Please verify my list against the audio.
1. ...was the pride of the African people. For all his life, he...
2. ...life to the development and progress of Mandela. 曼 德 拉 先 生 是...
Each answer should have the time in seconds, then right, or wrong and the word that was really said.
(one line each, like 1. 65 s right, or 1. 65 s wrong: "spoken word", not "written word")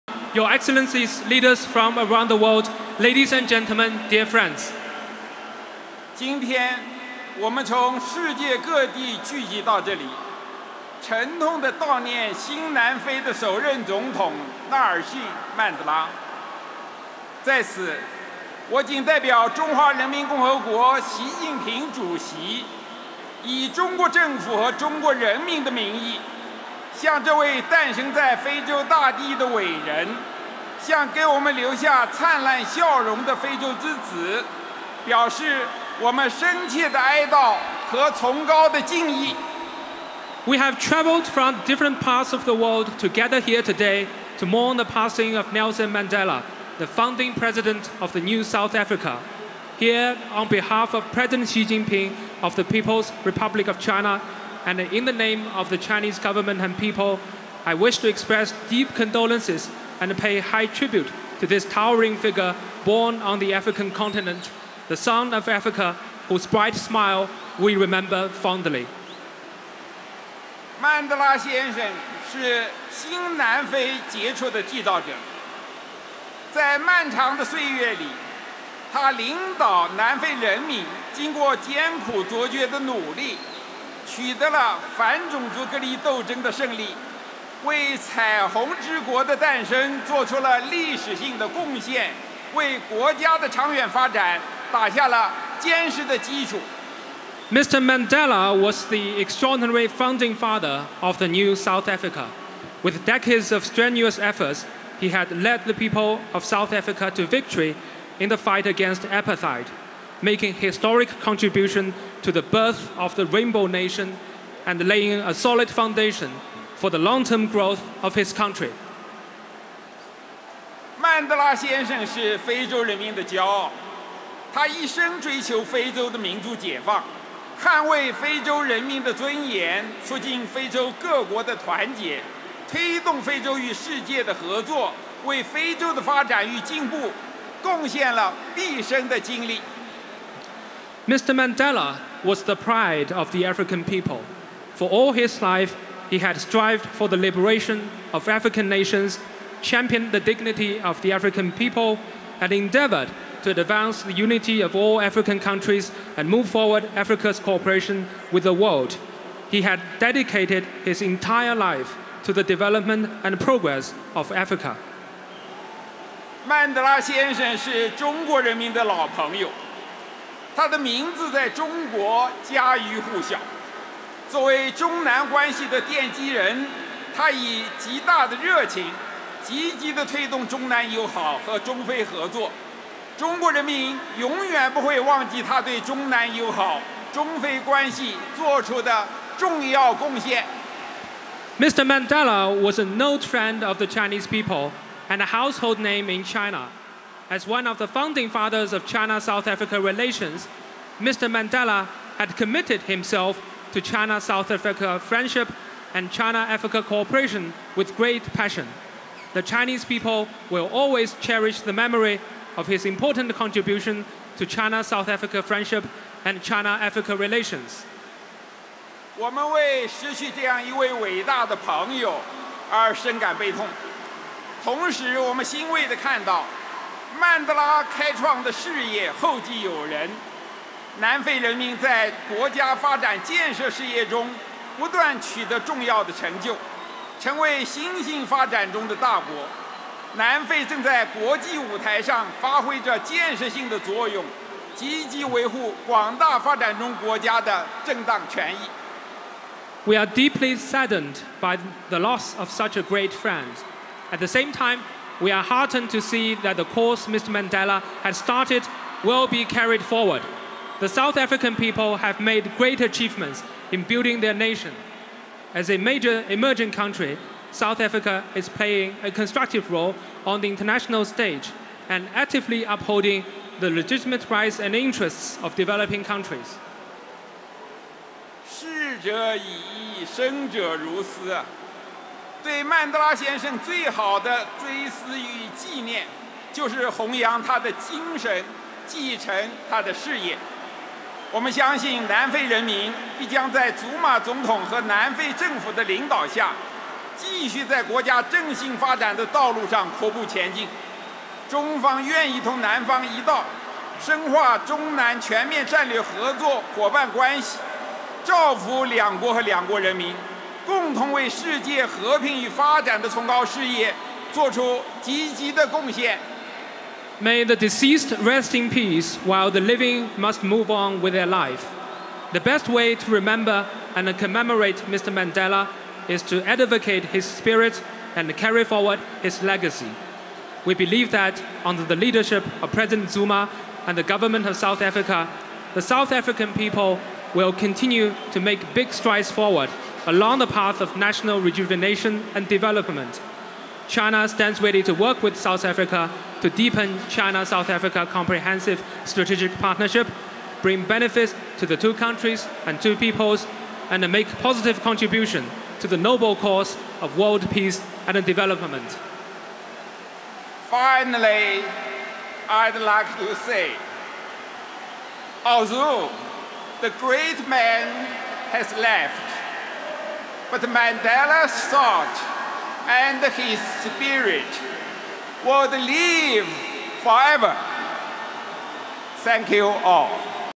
1. 142 s right
2. 161 s wrong: "Africa", not "Mandela".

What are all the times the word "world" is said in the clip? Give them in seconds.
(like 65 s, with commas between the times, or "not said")
2 s, 42 s, 158 s, 357 s.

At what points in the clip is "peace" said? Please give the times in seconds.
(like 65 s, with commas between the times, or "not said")
318 s, 357 s.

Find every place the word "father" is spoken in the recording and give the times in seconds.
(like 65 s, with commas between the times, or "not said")
100 s, 198 s.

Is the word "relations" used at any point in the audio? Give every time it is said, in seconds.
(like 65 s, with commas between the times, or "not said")
199 s, 217 s.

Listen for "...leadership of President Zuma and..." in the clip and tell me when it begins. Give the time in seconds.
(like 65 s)
331 s.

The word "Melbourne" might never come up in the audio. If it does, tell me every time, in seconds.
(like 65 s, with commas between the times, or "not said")
not said.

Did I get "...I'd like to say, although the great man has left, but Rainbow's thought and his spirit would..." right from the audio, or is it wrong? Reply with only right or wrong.
wrong.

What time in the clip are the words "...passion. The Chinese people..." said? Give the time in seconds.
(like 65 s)
208 s.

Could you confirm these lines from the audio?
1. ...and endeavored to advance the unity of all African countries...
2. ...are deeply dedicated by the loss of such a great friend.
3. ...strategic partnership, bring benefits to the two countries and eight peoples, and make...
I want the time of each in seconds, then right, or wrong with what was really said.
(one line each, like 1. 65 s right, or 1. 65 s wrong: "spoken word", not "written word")
1. 152 s right
2. 249 s wrong: "saddened", not "dedicated"
3. 349 s wrong: "two", not "eight".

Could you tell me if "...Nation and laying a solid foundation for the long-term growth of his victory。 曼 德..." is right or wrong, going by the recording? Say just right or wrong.
wrong.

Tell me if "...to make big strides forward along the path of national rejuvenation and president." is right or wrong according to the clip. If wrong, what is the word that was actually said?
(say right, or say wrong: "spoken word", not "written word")
wrong: "development", not "president".